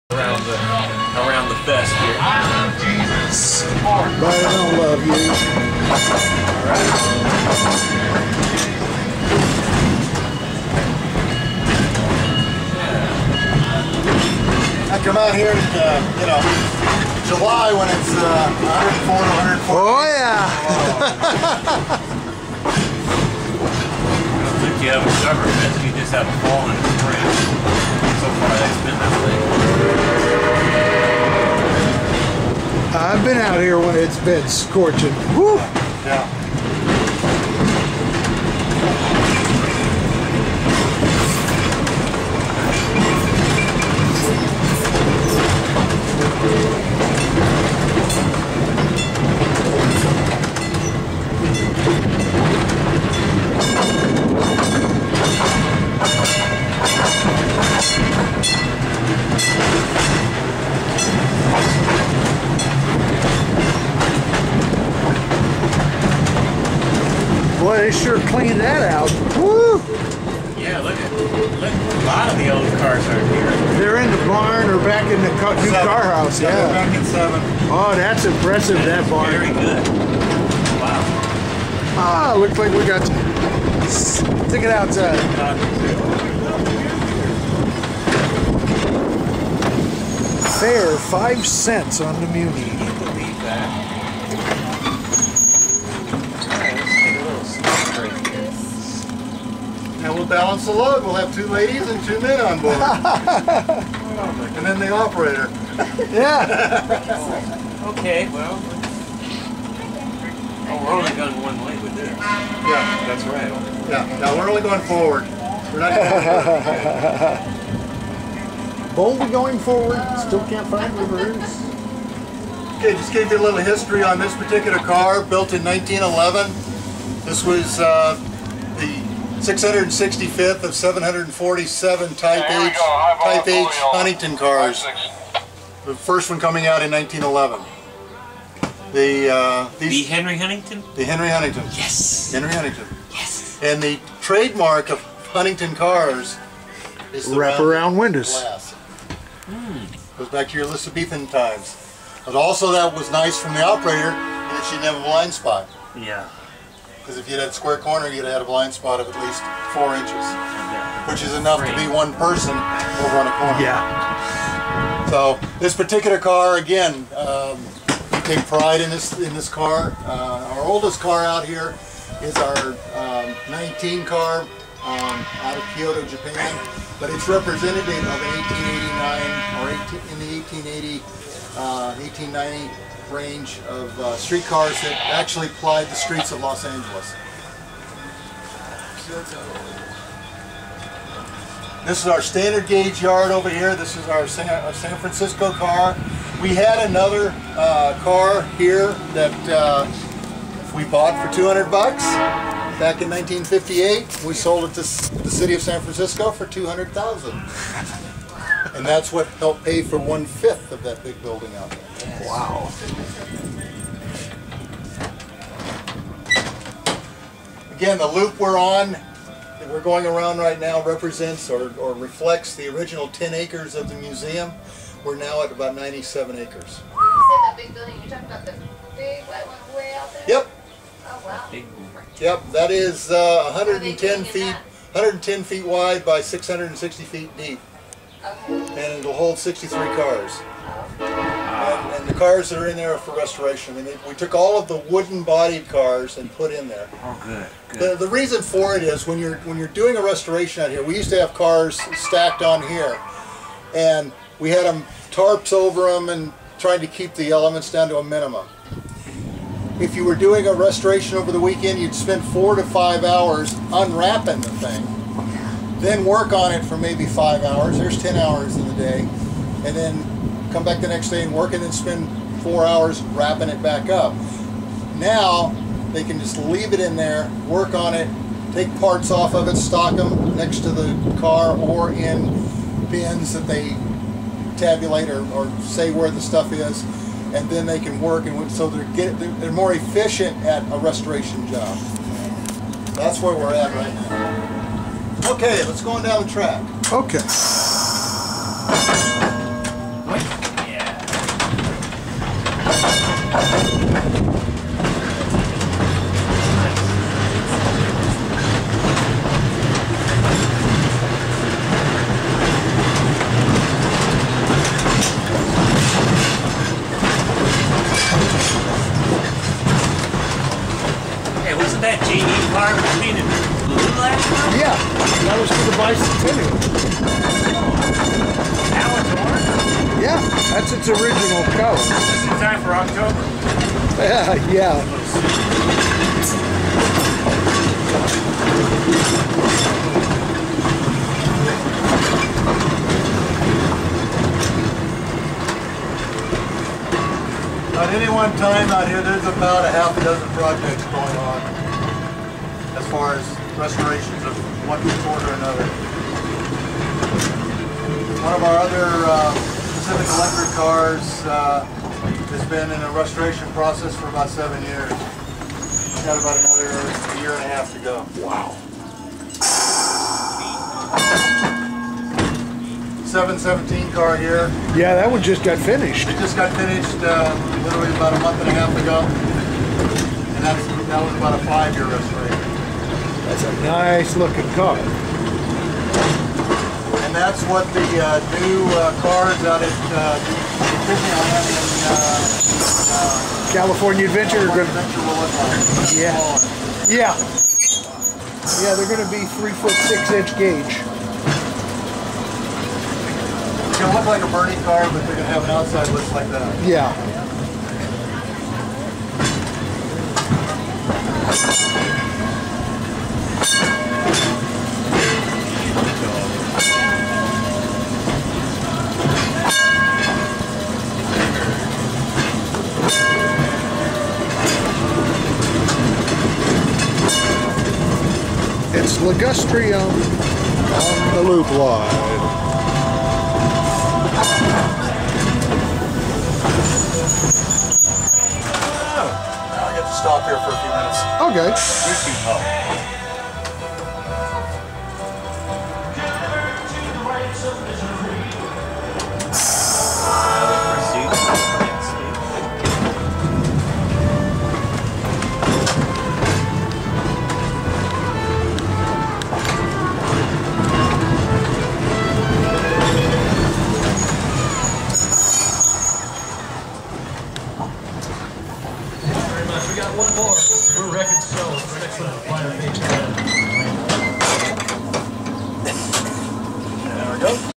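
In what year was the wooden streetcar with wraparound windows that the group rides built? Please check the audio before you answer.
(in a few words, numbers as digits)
1911.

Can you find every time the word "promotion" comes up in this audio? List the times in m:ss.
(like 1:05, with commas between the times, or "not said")
not said.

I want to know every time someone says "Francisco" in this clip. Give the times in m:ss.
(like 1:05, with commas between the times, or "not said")
3:14, 3:25.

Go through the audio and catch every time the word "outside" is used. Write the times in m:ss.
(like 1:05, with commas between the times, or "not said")
1:24, 6:45.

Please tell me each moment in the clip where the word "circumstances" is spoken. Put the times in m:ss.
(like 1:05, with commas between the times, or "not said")
not said.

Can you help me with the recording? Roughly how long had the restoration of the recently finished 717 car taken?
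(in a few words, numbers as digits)
about 5 years.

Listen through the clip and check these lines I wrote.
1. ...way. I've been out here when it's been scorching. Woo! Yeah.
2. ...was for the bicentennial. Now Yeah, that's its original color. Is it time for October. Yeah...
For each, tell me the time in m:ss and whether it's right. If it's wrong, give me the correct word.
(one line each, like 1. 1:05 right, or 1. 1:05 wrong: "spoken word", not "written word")
1. 0:29 right
2. 5:25 right.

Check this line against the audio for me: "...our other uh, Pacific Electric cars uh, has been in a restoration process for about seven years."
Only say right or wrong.
right.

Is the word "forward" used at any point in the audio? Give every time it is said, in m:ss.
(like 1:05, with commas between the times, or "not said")
1:54, 1:59.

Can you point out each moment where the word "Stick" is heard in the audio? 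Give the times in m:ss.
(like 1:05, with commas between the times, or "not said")
1:23.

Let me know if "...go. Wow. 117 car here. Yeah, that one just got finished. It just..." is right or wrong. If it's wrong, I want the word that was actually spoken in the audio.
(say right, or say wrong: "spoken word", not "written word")
wrong: "717", not "117".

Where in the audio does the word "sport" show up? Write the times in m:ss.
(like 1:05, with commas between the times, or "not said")
5:55.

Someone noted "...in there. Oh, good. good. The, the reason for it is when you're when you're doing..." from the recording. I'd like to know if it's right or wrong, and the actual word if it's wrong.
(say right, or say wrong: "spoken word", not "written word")
right.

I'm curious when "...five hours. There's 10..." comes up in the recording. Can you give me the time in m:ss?
4:27.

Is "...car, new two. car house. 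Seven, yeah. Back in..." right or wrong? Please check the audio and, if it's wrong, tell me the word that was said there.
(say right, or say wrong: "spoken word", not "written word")
wrong: "seven", not "two".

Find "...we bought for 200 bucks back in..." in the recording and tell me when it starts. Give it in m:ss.
3:20.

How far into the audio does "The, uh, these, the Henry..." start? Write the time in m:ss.
2:18.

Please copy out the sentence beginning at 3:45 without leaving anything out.
We're now at about 97 acres.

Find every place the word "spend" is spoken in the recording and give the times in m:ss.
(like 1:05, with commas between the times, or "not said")
4:21, 4:31.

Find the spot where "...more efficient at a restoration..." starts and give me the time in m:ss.
4:49.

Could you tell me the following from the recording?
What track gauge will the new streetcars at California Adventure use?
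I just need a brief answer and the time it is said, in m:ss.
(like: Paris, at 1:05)
3 feet 6 inches, at 6:39.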